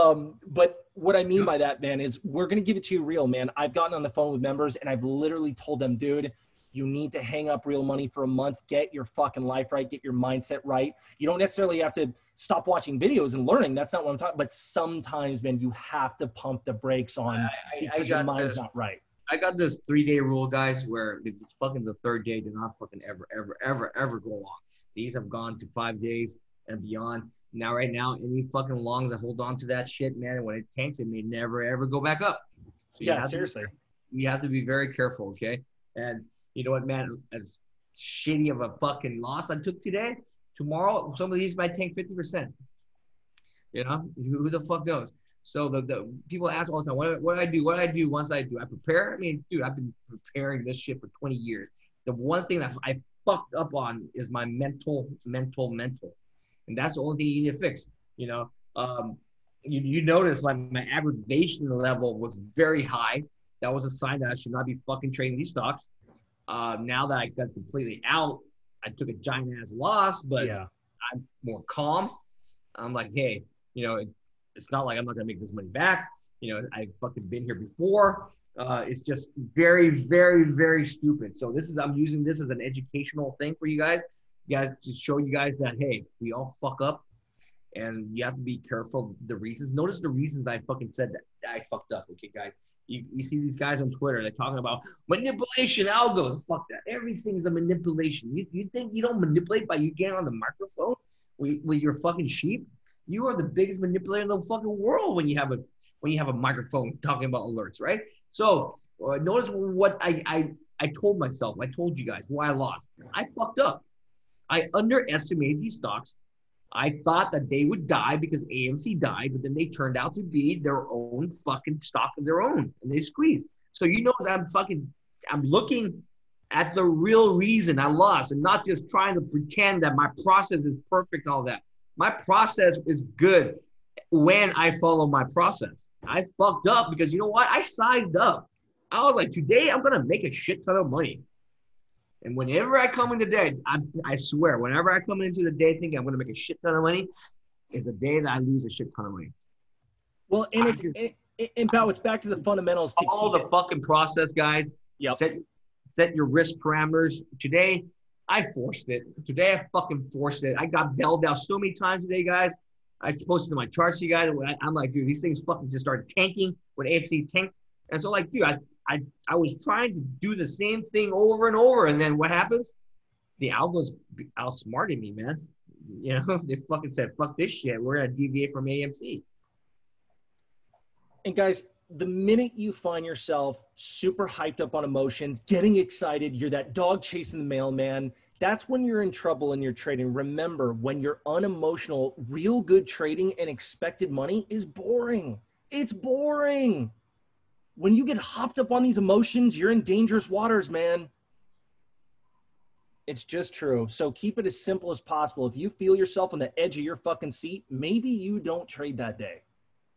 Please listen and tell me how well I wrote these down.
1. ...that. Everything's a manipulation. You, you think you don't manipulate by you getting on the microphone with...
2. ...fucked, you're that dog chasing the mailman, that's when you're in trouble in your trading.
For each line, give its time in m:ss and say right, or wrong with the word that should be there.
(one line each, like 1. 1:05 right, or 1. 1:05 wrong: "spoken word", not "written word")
1. 1:36 right
2. 3:05 wrong: "excited", not "fucked".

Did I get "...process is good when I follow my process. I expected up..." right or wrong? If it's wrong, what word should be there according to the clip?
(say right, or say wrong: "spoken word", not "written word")
wrong: "fucked", not "expected".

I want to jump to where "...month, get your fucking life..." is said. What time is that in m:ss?
0:08.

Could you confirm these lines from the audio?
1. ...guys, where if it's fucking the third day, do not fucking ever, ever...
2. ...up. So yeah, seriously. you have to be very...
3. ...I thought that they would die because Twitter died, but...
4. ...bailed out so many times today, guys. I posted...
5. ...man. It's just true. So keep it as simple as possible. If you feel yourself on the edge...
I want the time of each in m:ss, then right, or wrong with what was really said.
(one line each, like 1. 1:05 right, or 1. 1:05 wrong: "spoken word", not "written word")
1. 0:20 right
2. 0:32 right
3. 1:56 wrong: "AMC", not "Twitter"
4. 2:40 right
5. 3:20 right.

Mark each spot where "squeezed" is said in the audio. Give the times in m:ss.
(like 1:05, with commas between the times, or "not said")
2:02.